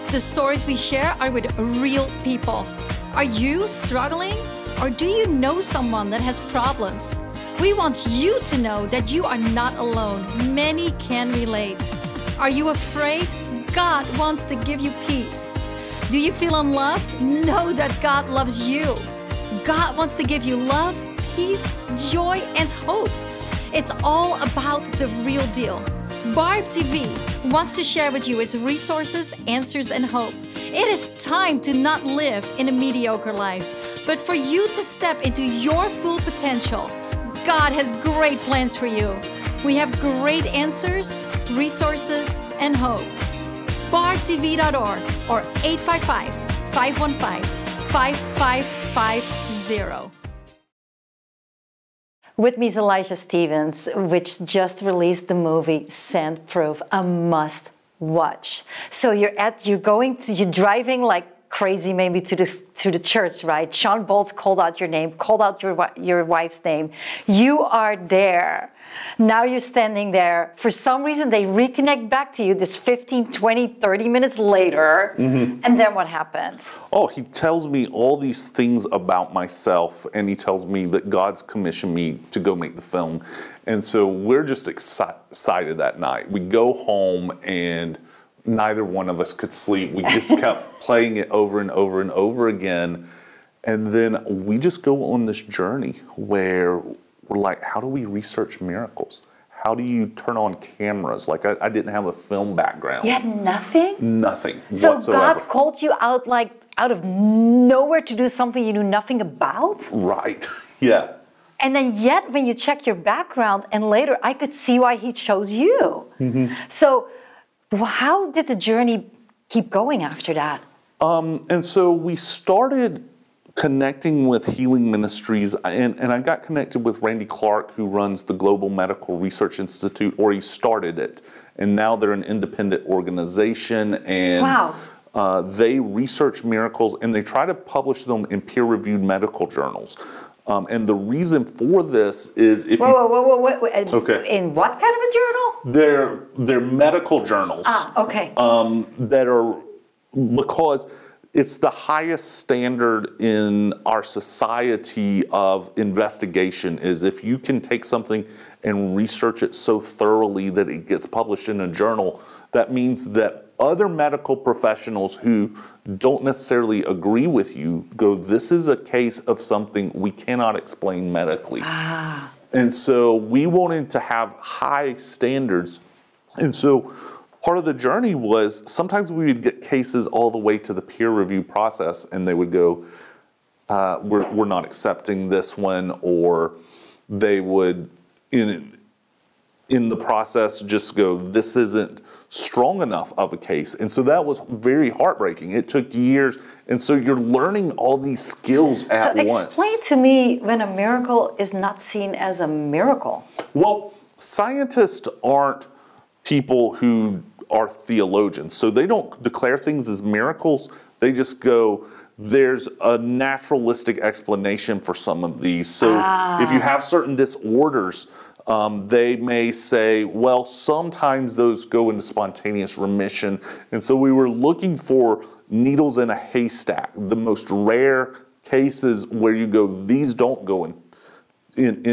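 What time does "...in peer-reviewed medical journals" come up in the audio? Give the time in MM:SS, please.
02:18.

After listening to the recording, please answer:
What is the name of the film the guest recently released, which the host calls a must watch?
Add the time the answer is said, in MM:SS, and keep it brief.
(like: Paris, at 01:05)
Send Proof, at 00:55.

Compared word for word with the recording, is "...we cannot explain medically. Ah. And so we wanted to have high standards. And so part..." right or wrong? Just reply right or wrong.
right.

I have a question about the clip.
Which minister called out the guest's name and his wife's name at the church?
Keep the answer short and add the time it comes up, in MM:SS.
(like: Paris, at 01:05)
Shawn Bolz, at 01:03.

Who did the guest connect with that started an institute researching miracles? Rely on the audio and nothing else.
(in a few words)
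Randy Clark.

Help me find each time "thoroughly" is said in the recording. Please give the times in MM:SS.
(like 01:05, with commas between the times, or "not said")
02:39.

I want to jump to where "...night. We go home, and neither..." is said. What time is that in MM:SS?
01:25.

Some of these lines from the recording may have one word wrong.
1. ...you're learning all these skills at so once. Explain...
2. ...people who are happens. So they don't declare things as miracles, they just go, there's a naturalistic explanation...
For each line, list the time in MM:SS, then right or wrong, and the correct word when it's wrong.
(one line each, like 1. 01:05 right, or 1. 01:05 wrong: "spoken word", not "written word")
1. 03:16 right
2. 03:26 wrong: "theologians", not "happens".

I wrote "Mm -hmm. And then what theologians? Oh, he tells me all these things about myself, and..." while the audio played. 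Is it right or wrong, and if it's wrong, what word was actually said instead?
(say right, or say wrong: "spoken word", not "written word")
wrong: "happens", not "theologians".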